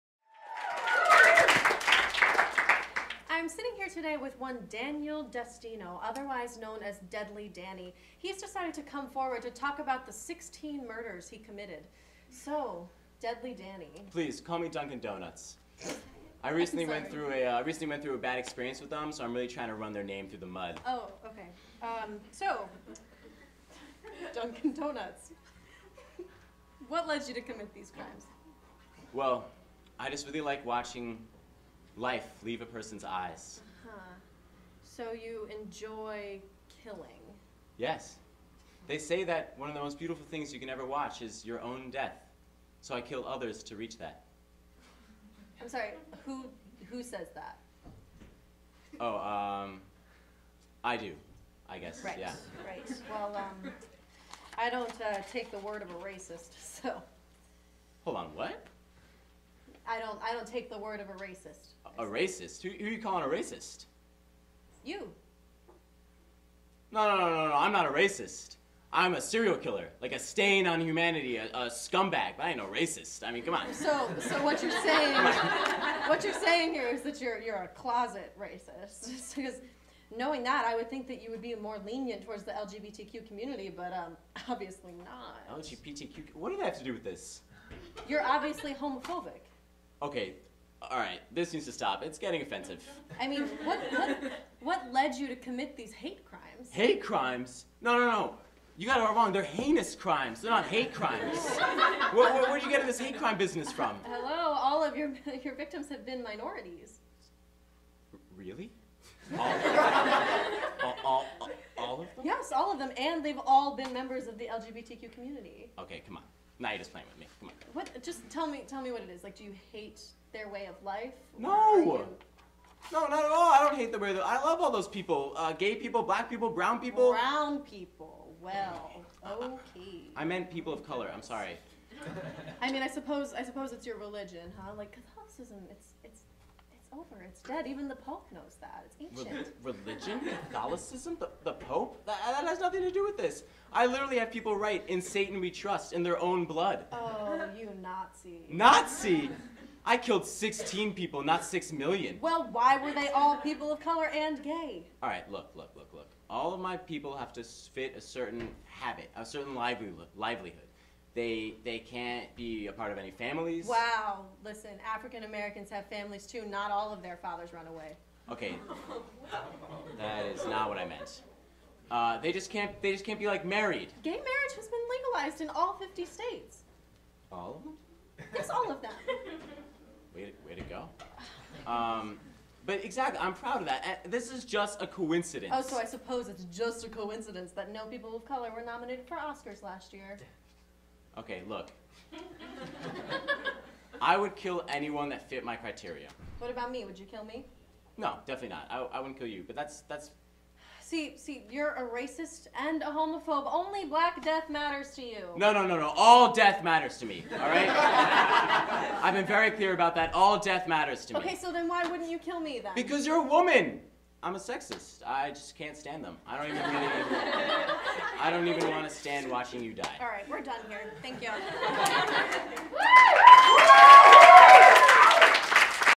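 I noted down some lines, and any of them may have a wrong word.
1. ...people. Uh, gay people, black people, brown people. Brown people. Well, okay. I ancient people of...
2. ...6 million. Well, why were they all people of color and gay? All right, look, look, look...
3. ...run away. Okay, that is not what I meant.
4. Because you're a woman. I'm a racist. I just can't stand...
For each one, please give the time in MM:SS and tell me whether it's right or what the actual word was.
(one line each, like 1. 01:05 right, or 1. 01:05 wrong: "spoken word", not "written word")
1. 02:04 wrong: "meant", not "ancient"
2. 02:31 right
3. 02:47 right
4. 03:32 wrong: "sexist", not "racist".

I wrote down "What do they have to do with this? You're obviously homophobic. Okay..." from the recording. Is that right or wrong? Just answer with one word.
right.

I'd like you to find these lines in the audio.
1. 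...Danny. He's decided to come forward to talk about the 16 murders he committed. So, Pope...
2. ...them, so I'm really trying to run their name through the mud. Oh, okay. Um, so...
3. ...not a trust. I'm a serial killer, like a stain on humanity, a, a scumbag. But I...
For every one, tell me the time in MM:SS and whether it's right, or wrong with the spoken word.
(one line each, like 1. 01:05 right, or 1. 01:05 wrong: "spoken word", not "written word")
1. 00:07 wrong: "Deadly", not "Pope"
2. 00:18 right
3. 01:07 wrong: "racist", not "trust".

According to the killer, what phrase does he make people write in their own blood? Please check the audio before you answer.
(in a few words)
In Satan we trust.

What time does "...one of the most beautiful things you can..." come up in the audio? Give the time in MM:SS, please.
00:39.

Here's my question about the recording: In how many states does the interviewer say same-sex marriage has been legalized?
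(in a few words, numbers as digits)
50.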